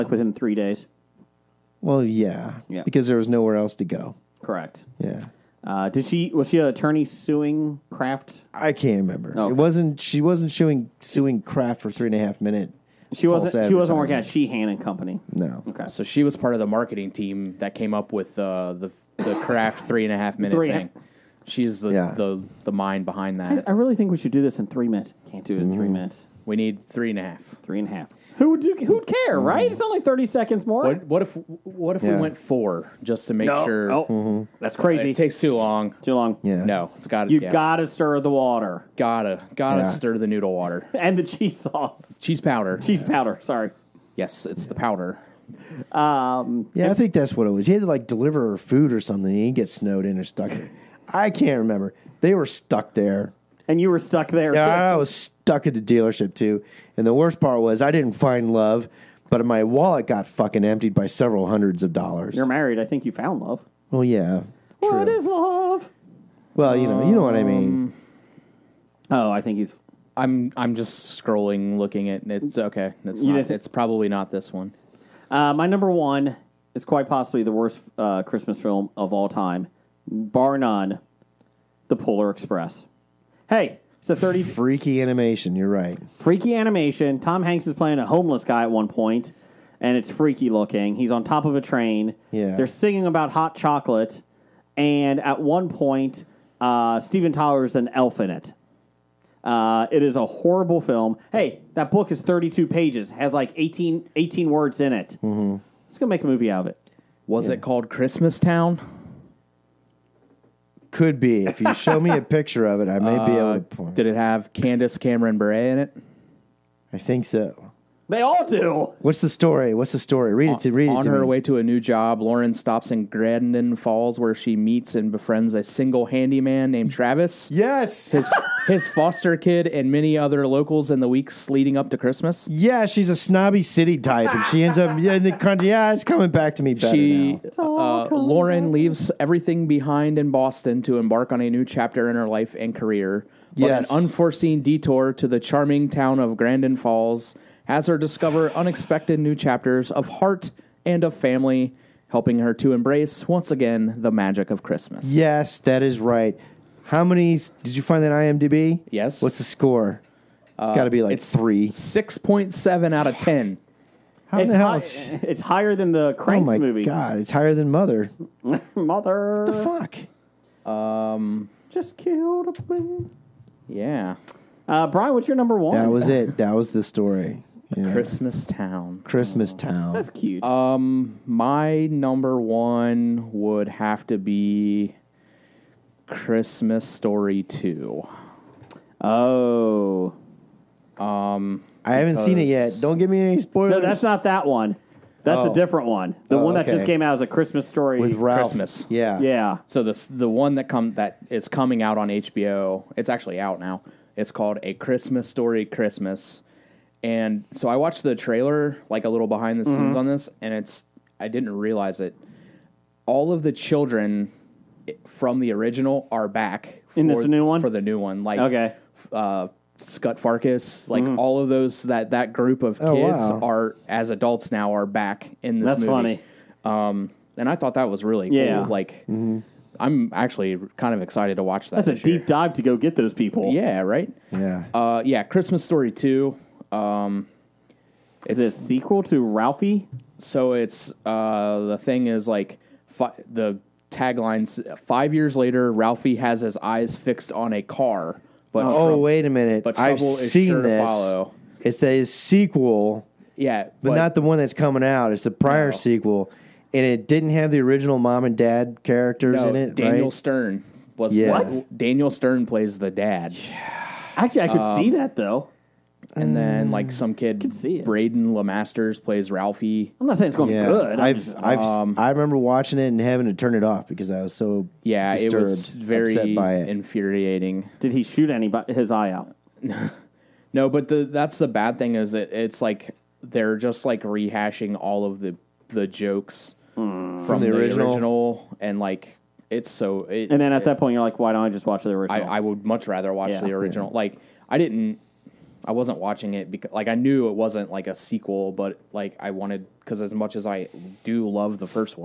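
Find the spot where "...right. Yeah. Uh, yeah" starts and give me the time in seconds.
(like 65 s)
233 s.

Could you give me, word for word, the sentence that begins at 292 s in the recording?
I, I would much rather watch Yeah.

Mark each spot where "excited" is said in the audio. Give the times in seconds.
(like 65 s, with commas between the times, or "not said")
231 s.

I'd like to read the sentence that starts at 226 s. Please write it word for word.
Um, and I thought that was really yeah.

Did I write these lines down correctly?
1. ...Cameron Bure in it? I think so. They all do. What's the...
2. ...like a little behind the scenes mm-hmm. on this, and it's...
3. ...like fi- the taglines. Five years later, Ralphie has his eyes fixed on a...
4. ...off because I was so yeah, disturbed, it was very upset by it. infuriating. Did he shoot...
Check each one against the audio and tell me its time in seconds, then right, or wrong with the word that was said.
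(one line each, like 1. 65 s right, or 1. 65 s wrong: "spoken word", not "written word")
1. 114 s right
2. 208 s right
3. 242 s right
4. 273 s right.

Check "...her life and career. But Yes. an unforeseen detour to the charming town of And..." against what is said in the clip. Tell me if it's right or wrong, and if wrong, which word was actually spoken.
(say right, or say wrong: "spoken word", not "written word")
wrong: "Grandin", not "And".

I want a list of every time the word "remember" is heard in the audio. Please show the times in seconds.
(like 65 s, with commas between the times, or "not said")
8 s, 51 s, 272 s.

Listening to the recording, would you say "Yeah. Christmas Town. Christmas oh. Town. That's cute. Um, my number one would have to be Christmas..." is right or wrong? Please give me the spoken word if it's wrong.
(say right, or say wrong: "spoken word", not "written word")
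right.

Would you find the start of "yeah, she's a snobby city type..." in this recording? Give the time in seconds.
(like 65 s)
132 s.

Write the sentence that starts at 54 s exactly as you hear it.
Yeah, I was stuck at the dealership too.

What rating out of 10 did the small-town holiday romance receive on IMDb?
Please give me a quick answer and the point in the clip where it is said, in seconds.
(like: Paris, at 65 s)
6.7, at 161 s.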